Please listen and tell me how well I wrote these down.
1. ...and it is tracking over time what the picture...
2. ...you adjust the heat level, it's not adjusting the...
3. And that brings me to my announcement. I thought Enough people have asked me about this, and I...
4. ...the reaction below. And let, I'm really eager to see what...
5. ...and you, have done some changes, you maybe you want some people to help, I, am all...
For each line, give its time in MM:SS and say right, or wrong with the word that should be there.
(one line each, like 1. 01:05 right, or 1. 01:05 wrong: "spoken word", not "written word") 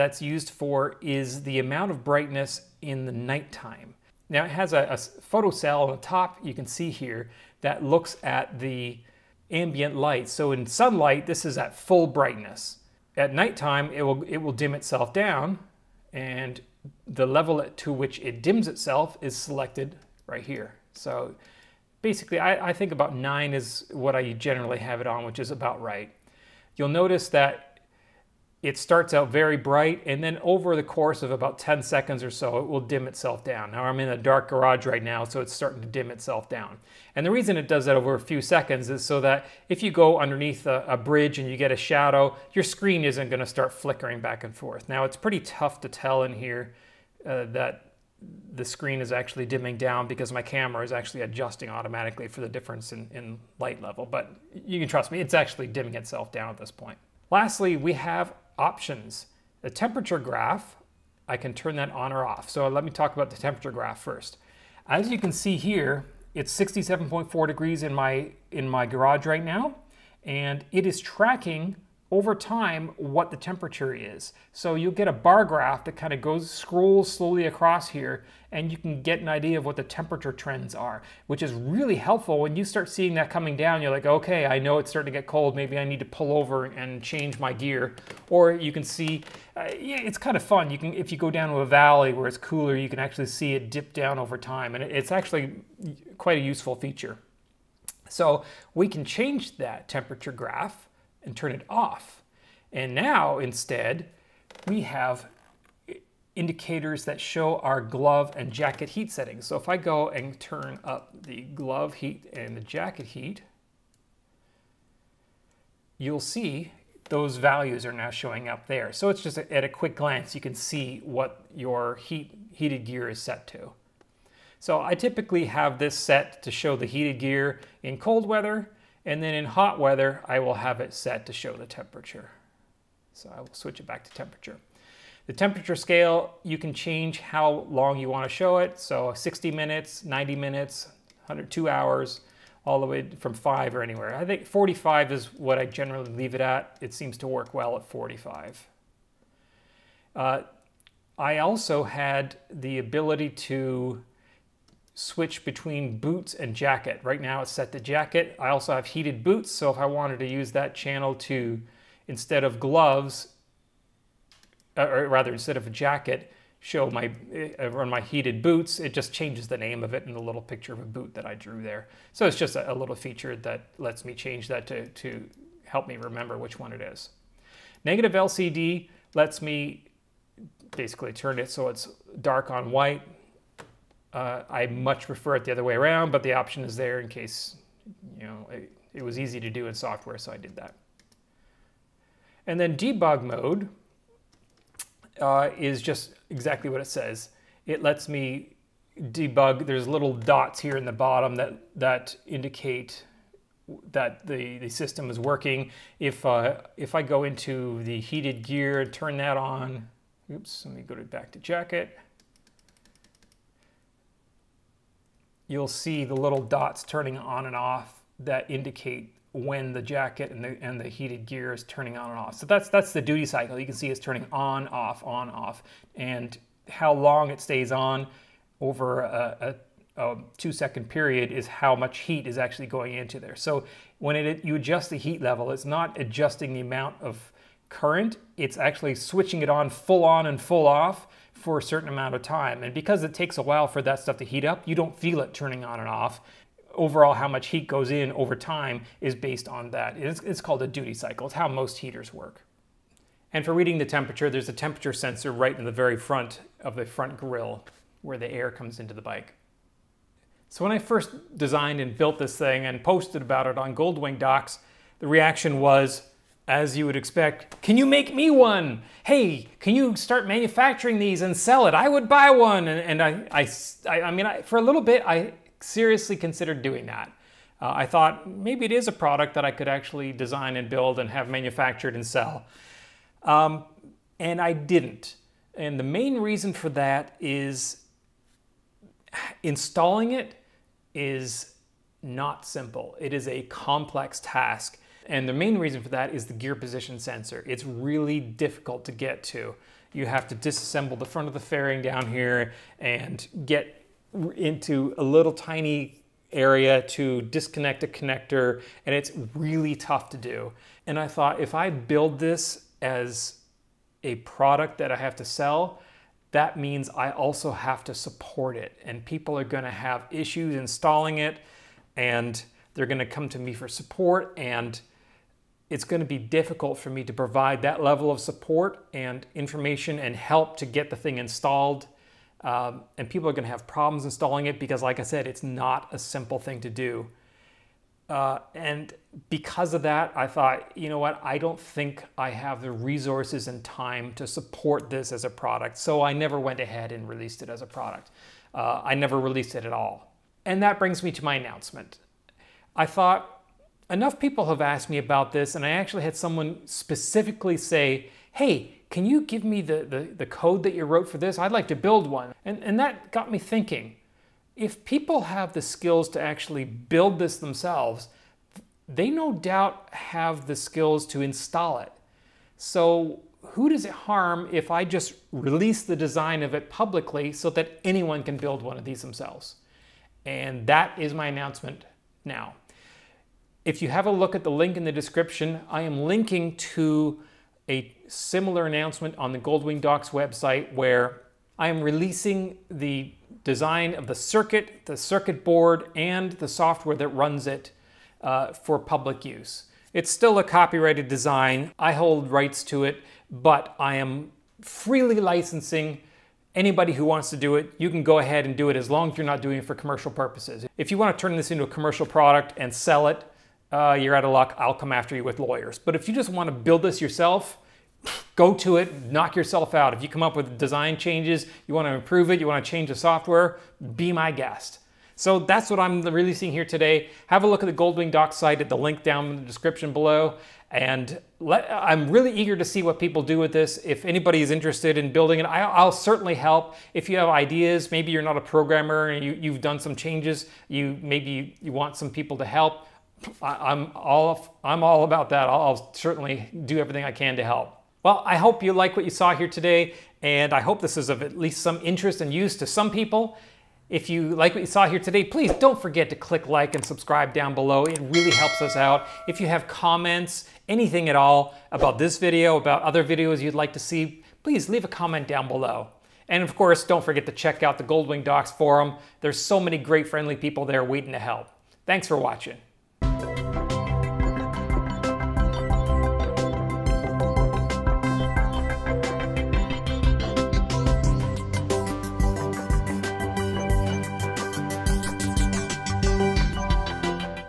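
1. 01:10 wrong: "temperature", not "picture"
2. 03:54 right
3. 05:50 right
4. 07:09 wrong: "description", not "reaction"
5. 07:19 right.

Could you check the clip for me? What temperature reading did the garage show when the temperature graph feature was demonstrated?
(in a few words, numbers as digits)
67.4 degrees.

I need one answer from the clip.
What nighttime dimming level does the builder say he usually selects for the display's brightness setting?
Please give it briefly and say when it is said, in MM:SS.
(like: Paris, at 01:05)
9, at 00:23.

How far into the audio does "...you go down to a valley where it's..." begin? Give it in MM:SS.
01:31.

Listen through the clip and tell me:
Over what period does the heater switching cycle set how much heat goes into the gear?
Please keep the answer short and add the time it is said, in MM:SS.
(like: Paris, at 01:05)
2 seconds, at 03:50.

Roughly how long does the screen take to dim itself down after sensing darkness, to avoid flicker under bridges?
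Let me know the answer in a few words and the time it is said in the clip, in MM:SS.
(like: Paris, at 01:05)
10 seconds, at 00:31.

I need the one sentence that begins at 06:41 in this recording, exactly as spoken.
I hold rights to it, but I am freely licensing anybody who wants to do it.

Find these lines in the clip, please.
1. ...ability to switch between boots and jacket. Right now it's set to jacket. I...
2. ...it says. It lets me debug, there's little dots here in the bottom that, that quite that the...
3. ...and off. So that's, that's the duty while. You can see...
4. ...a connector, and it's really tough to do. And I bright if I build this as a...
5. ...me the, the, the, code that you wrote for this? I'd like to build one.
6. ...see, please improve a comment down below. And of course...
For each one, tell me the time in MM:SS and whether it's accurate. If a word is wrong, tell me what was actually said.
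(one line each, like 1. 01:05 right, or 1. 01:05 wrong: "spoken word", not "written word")
1. 02:32 right
2. 03:16 wrong: "indicate", not "quite"
3. 03:42 wrong: "cycle", not "while"
4. 05:07 wrong: "thought", not "bright"
5. 05:59 right
6. 07:43 wrong: "leave", not "improve".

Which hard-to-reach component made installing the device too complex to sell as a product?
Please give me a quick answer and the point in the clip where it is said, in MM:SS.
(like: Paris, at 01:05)
gear position sensor, at 04:56.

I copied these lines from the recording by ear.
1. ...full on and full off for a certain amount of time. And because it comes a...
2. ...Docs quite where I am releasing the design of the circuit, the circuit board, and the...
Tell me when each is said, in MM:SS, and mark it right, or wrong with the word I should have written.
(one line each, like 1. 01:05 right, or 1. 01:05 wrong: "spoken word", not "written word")
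1. 03:59 wrong: "takes", not "comes"
2. 06:29 wrong: "website", not "quite".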